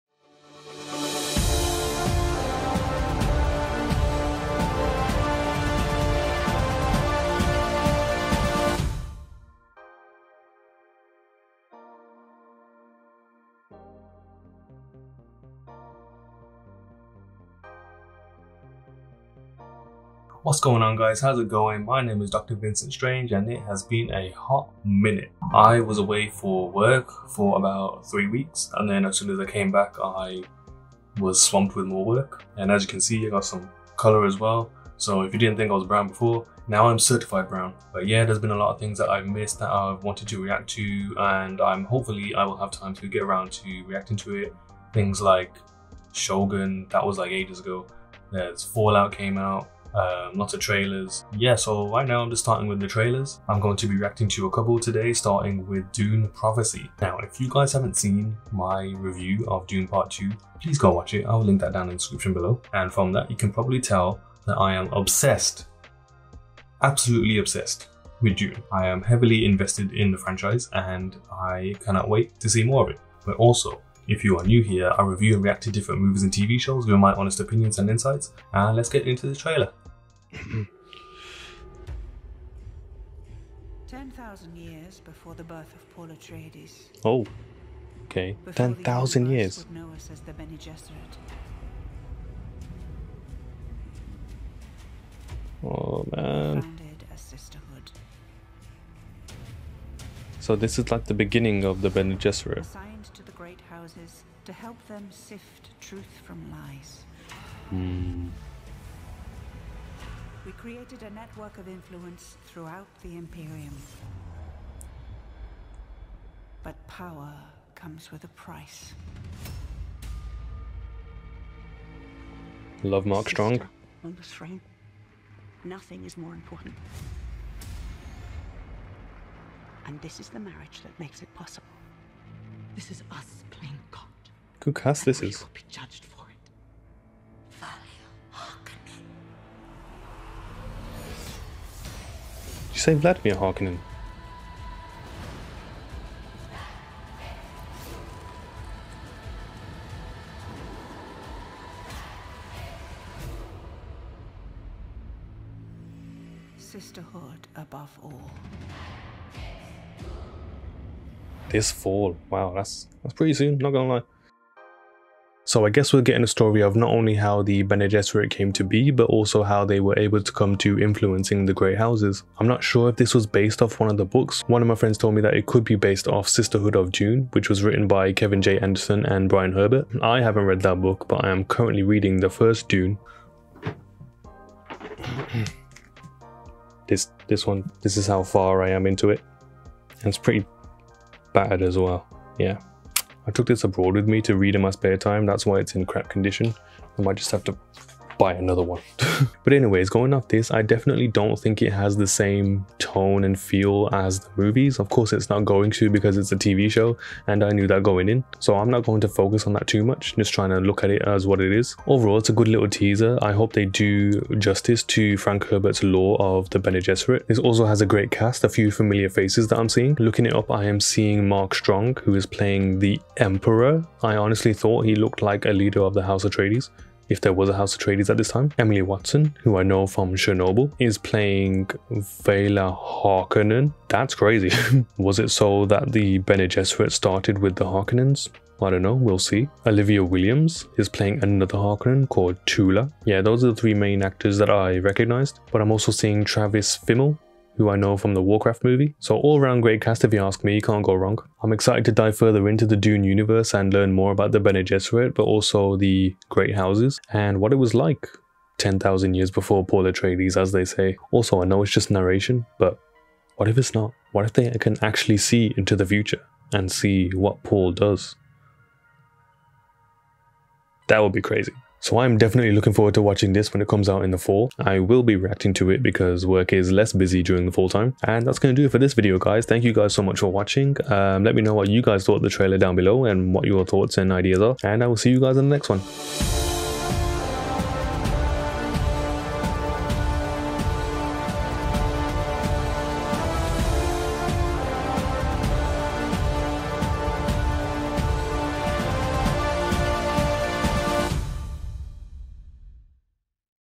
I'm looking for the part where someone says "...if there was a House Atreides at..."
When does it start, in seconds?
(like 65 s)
227 s.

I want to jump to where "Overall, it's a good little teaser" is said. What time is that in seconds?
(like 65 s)
211 s.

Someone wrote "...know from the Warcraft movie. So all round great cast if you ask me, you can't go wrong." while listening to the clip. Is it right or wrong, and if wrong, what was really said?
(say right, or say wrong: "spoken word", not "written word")
right.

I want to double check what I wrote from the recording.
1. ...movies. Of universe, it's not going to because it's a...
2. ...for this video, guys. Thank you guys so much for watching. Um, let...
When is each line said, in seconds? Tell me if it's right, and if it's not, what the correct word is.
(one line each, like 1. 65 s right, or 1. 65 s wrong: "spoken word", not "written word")
1. 204 s wrong: "course", not "universe"
2. 278 s right.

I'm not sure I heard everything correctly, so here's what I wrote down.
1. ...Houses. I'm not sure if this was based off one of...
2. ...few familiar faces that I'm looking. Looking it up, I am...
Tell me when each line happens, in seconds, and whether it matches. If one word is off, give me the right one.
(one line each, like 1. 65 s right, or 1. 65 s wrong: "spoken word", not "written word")
1. 171 s right
2. 218 s wrong: "seeing", not "looking".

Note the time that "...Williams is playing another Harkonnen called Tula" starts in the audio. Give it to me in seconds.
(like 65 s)
240 s.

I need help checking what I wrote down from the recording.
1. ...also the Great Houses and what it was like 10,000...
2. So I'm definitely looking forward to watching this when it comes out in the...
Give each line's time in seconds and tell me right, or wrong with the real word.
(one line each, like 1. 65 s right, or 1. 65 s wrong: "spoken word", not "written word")
1. 255 s right
2. 271 s right.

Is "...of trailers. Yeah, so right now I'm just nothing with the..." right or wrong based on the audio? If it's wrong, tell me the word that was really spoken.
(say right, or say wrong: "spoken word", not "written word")
wrong: "starting", not "nothing".